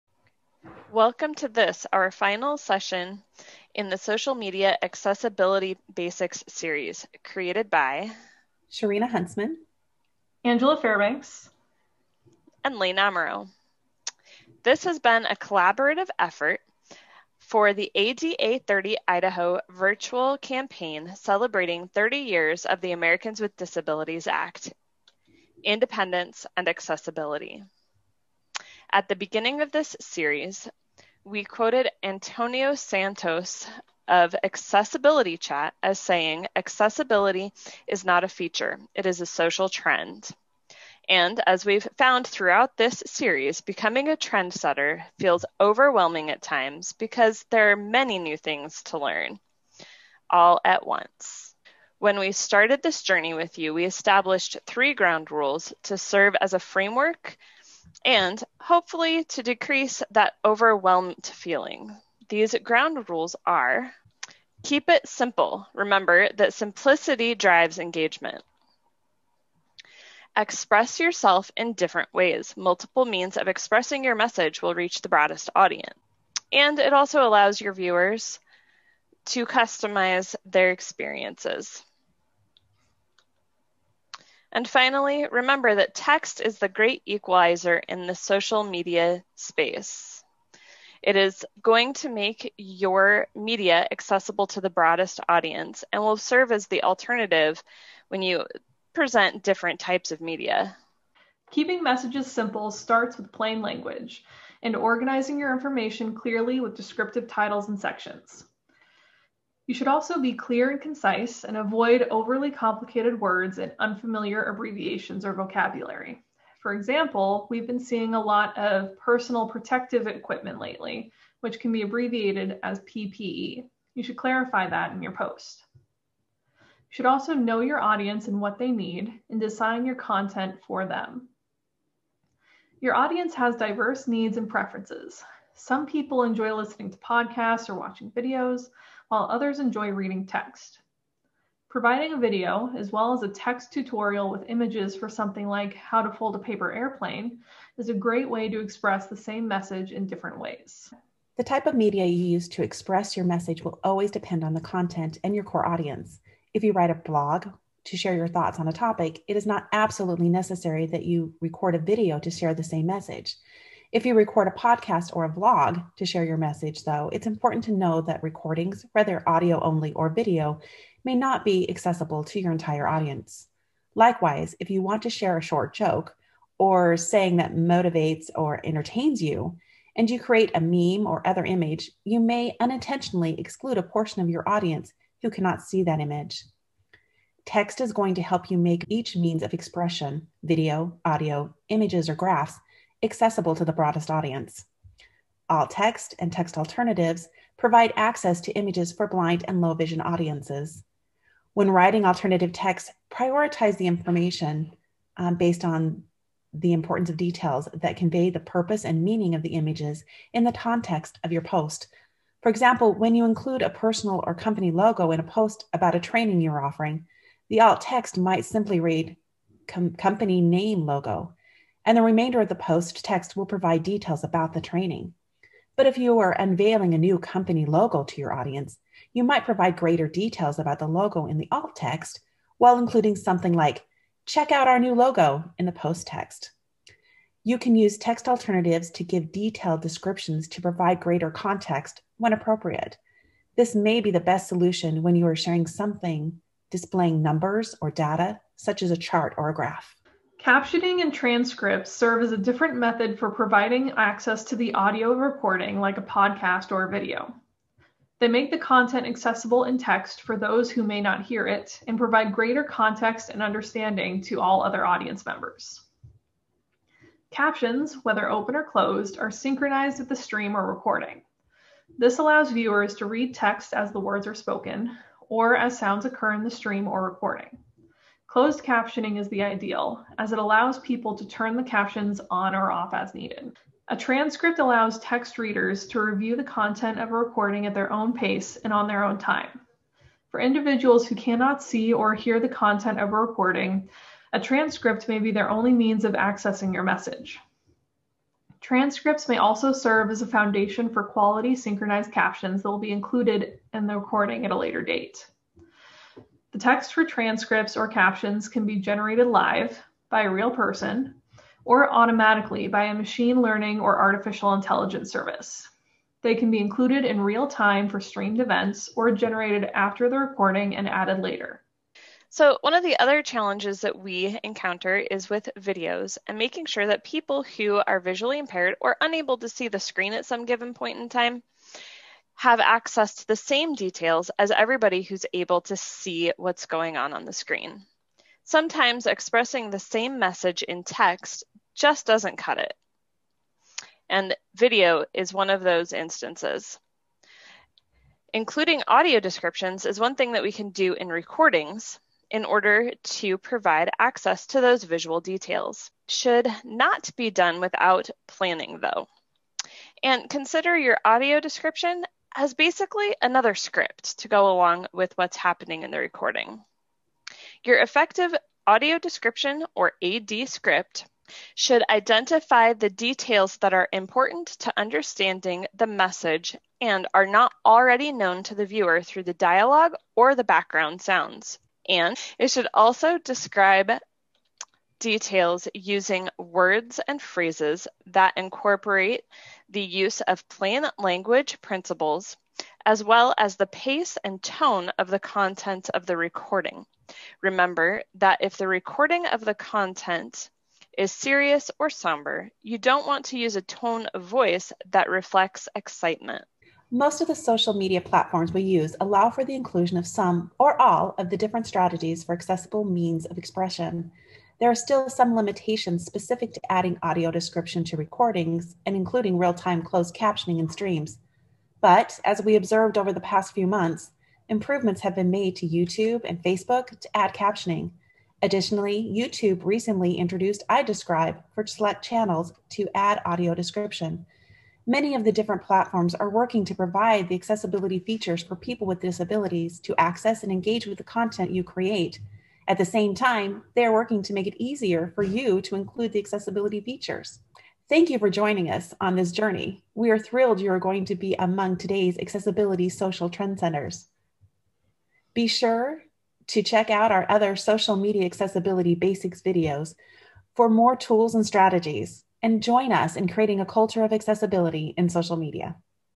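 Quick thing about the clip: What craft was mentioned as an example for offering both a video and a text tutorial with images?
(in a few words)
paper airplane.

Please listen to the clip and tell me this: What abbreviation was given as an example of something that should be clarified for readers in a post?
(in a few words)
PPE.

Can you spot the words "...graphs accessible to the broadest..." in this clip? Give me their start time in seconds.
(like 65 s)
192 s.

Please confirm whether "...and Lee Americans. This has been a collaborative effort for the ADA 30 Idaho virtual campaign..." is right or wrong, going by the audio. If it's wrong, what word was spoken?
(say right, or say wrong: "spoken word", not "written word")
wrong: "Namaro", not "Americans".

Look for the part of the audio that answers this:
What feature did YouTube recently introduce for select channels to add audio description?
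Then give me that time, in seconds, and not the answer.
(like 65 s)
430 s.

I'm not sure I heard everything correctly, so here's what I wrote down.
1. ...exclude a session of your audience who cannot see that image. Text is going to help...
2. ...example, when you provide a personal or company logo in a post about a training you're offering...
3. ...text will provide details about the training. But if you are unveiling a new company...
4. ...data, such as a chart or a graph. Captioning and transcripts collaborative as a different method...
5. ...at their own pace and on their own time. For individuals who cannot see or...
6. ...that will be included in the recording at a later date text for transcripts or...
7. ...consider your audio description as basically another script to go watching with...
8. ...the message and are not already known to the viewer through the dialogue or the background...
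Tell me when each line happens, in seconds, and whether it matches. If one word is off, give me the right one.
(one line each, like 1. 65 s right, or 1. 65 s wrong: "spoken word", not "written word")
1. 183 s wrong: "portion", not "session"
2. 212 s wrong: "include", not "provide"
3. 223 s right
4. 247 s wrong: "serve", not "collaborative"
5. 287 s right
6. 302 s right
7. 360 s wrong: "along", not "watching"
8. 375 s right.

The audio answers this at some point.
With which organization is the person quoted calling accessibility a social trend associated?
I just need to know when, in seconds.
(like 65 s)
34 s.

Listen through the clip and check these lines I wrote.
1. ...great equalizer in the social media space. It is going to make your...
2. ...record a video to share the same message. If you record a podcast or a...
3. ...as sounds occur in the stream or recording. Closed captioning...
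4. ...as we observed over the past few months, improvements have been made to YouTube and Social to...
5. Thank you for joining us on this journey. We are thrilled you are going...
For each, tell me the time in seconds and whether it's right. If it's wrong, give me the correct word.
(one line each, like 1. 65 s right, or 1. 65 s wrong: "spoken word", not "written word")
1. 86 s right
2. 161 s right
3. 275 s right
4. 422 s wrong: "Facebook", not "Social"
5. 447 s right.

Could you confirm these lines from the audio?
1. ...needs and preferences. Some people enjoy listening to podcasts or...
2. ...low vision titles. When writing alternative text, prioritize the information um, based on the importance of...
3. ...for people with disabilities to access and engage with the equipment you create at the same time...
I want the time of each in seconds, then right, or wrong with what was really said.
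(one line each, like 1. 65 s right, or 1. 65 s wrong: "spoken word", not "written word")
1. 134 s right
2. 199 s wrong: "audiences", not "titles"
3. 438 s wrong: "content", not "equipment".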